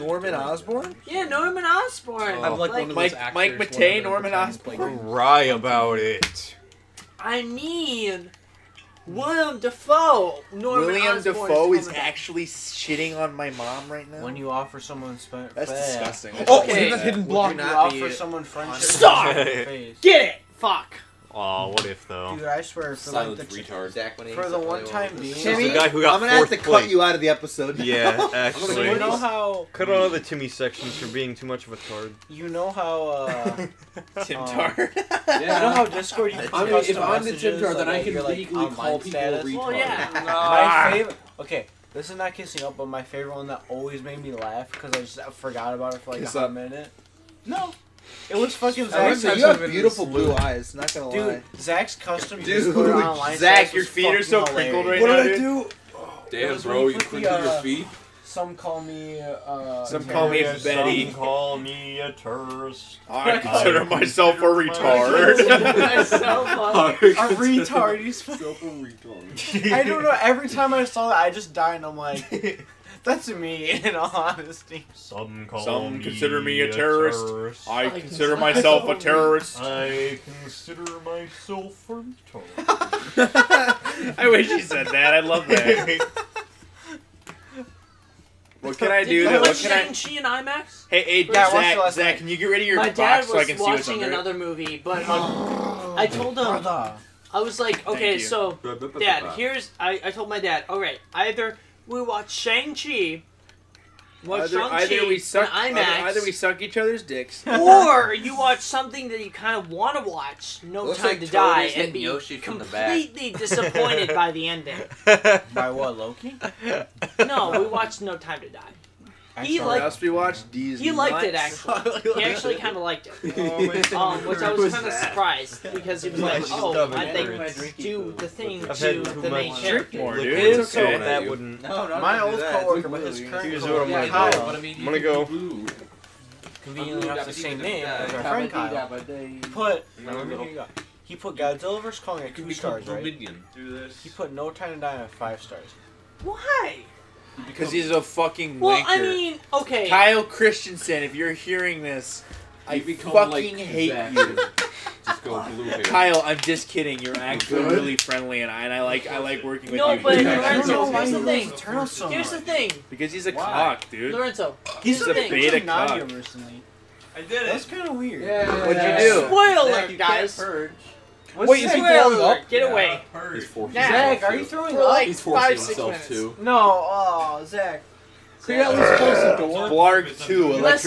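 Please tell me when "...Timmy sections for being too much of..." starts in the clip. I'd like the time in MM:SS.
00:30.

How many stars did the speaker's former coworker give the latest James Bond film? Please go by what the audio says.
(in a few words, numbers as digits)
5 stars.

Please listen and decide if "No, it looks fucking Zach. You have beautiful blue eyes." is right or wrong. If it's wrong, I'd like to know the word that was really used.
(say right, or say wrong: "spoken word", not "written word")
right.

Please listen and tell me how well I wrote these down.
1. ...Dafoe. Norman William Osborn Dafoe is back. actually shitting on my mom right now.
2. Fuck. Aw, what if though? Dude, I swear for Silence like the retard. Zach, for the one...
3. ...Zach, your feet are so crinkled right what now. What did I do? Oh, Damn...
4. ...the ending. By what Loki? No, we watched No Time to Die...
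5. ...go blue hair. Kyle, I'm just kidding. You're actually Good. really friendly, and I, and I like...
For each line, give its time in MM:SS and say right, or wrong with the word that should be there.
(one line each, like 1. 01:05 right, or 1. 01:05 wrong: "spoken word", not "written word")
1. 00:09 right
2. 00:20 right
3. 00:53 right
4. 01:54 right
5. 02:35 right.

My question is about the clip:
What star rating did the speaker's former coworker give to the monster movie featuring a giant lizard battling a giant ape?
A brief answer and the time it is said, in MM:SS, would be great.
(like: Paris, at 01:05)
2 stars, at 02:22.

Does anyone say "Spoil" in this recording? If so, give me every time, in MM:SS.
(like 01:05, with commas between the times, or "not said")
02:49.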